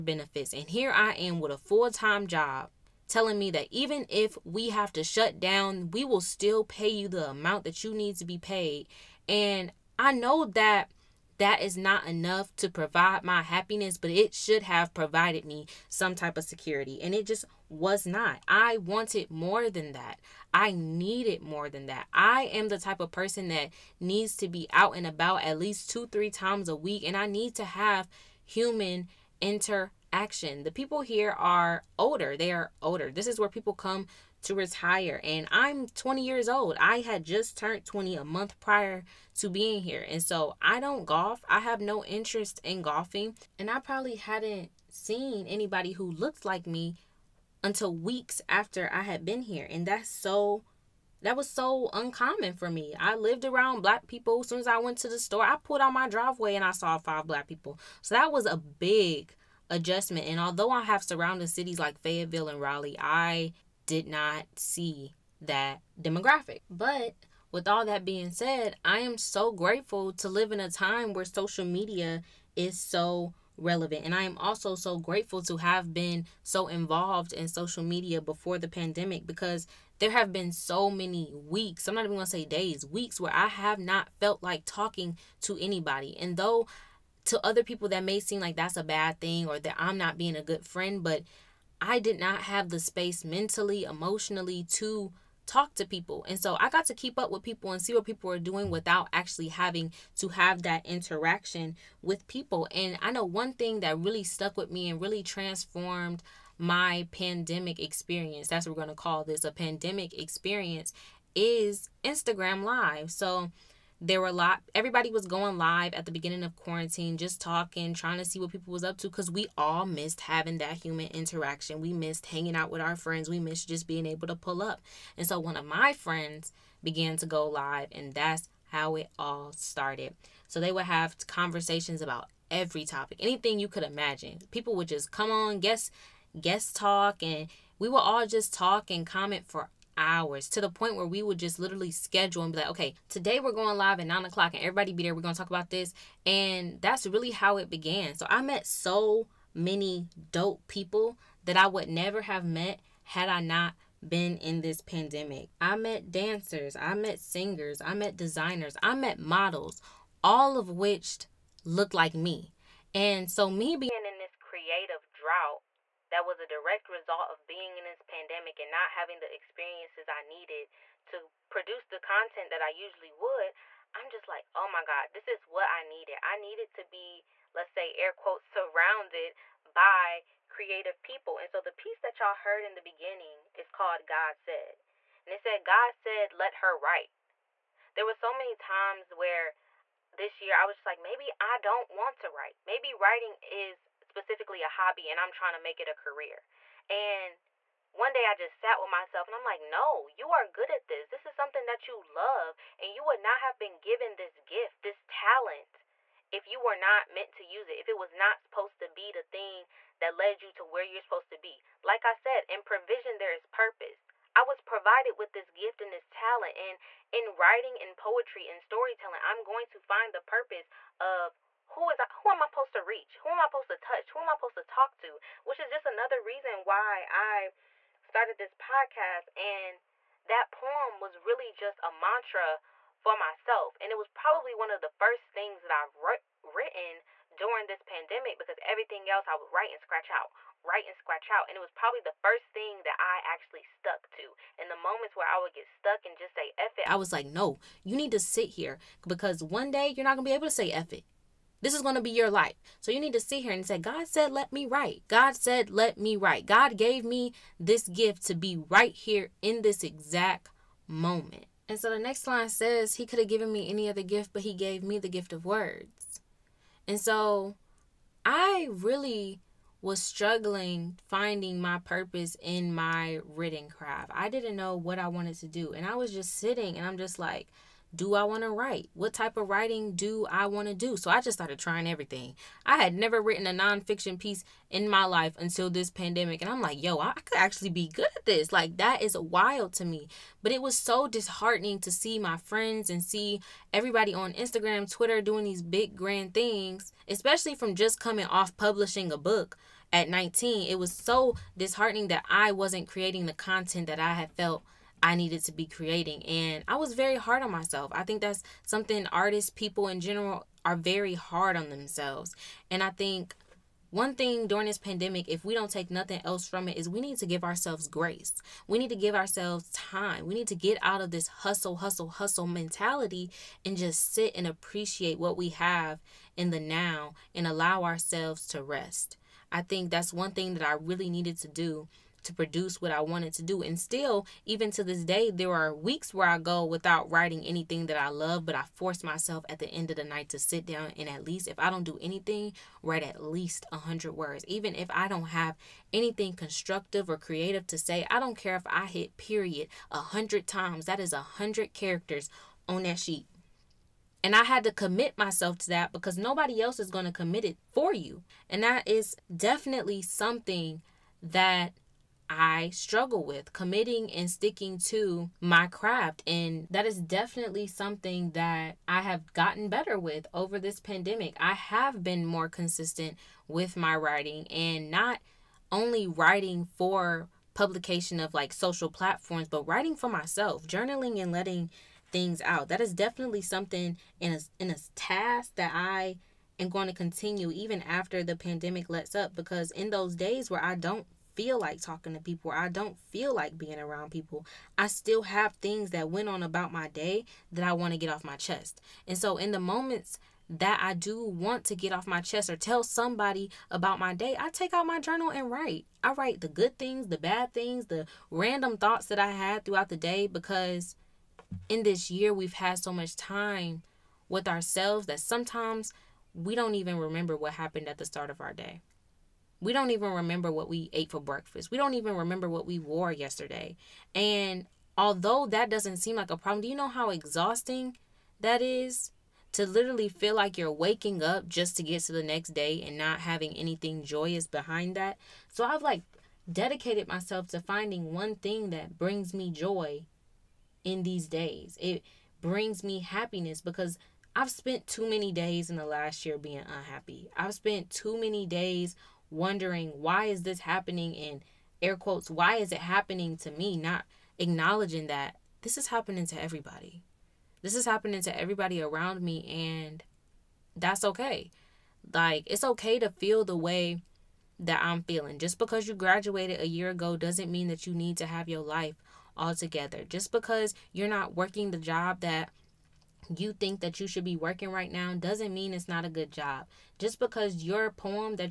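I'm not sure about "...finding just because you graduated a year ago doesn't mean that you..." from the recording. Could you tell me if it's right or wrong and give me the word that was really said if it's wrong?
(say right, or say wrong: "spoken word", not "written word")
wrong: "feeling", not "finding".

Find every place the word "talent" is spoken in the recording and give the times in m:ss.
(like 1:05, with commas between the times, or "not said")
3:25, 3:36.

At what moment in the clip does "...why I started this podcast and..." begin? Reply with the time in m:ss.
3:46.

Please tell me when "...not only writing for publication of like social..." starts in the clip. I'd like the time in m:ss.
6:14.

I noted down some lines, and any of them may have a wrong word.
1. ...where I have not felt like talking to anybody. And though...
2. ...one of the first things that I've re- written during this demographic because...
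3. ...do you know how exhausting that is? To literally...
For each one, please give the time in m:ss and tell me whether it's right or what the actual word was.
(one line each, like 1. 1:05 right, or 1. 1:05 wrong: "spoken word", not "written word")
1. 1:23 right
2. 3:54 wrong: "pandemic", not "demographic"
3. 7:06 right.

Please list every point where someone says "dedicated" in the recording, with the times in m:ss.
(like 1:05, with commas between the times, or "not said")
7:16.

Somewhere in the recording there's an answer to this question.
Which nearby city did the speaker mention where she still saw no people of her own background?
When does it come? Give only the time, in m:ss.
1:01.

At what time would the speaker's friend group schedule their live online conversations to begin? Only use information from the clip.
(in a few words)
9:00.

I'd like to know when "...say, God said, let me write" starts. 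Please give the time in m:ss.
4:13.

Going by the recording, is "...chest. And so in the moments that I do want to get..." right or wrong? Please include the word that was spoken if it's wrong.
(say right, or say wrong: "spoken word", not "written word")
right.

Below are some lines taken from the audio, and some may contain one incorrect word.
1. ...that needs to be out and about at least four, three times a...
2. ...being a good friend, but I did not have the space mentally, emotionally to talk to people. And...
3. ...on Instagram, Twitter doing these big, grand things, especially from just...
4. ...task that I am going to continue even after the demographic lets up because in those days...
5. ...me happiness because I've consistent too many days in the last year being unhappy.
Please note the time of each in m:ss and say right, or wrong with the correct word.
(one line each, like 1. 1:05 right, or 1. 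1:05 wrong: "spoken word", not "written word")
1. 0:23 wrong: "two", not "four"
2. 1:30 right
3. 4:54 right
4. 6:24 wrong: "pandemic", not "demographic"
5. 7:22 wrong: "spent", not "consistent".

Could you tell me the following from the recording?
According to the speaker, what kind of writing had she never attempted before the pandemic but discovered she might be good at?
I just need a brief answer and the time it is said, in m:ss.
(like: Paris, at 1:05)
nonfiction, at 4:43.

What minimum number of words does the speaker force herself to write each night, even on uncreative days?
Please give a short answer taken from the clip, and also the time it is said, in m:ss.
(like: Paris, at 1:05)
100, at 5:43.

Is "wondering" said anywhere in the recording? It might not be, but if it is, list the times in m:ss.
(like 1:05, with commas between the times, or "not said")
7:29.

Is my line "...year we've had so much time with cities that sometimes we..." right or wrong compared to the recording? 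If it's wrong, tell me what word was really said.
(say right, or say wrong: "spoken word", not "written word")
wrong: "ourselves", not "cities".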